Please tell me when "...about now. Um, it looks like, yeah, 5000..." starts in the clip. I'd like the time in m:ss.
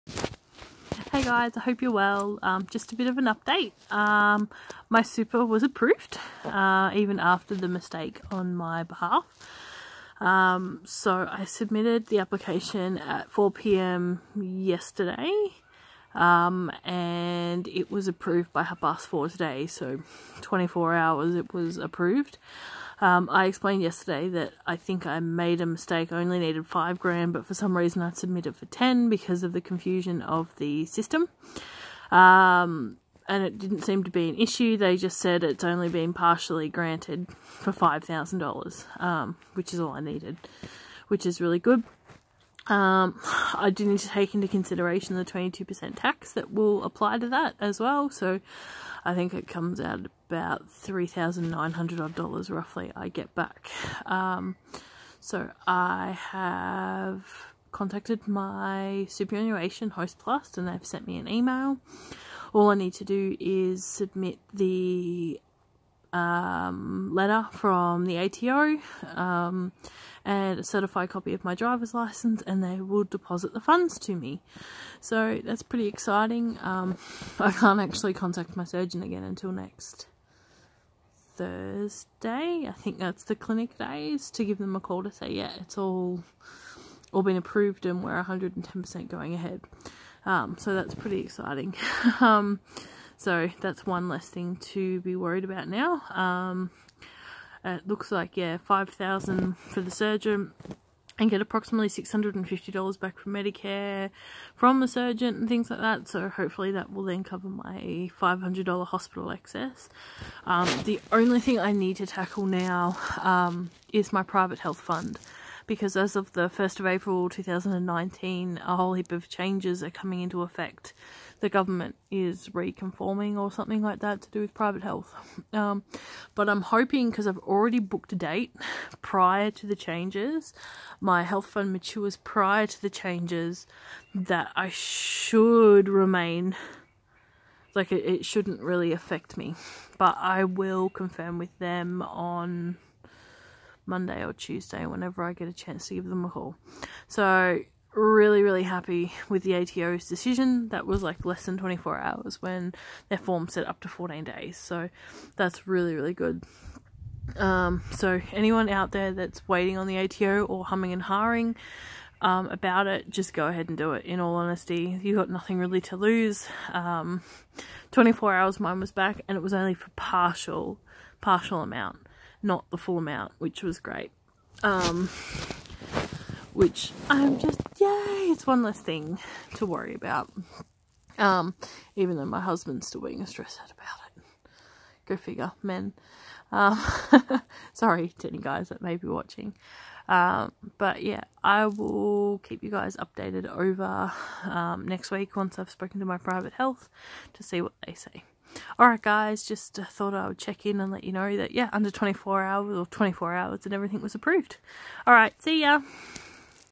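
1:35.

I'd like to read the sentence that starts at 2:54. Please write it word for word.
Um, which I'm just, yay, it's one less thing to worry about.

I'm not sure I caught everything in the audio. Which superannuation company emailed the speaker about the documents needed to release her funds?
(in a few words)
Hostplus.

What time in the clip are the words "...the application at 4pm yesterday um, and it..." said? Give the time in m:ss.
0:12.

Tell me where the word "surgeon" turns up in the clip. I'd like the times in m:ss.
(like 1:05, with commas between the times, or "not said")
1:18, 1:39, 1:44.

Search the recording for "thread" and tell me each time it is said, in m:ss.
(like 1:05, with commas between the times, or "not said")
not said.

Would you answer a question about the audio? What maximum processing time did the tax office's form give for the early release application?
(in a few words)
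14 days.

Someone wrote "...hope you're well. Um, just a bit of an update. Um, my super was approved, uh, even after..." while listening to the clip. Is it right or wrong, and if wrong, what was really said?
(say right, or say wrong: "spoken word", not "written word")
right.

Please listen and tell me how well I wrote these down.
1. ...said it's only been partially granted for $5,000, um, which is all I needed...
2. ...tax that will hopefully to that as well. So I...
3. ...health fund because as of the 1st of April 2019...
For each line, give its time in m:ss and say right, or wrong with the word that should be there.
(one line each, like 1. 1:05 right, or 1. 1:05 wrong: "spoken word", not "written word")
1. 0:35 right
2. 0:45 wrong: "apply", not "hopefully"
3. 1:54 right.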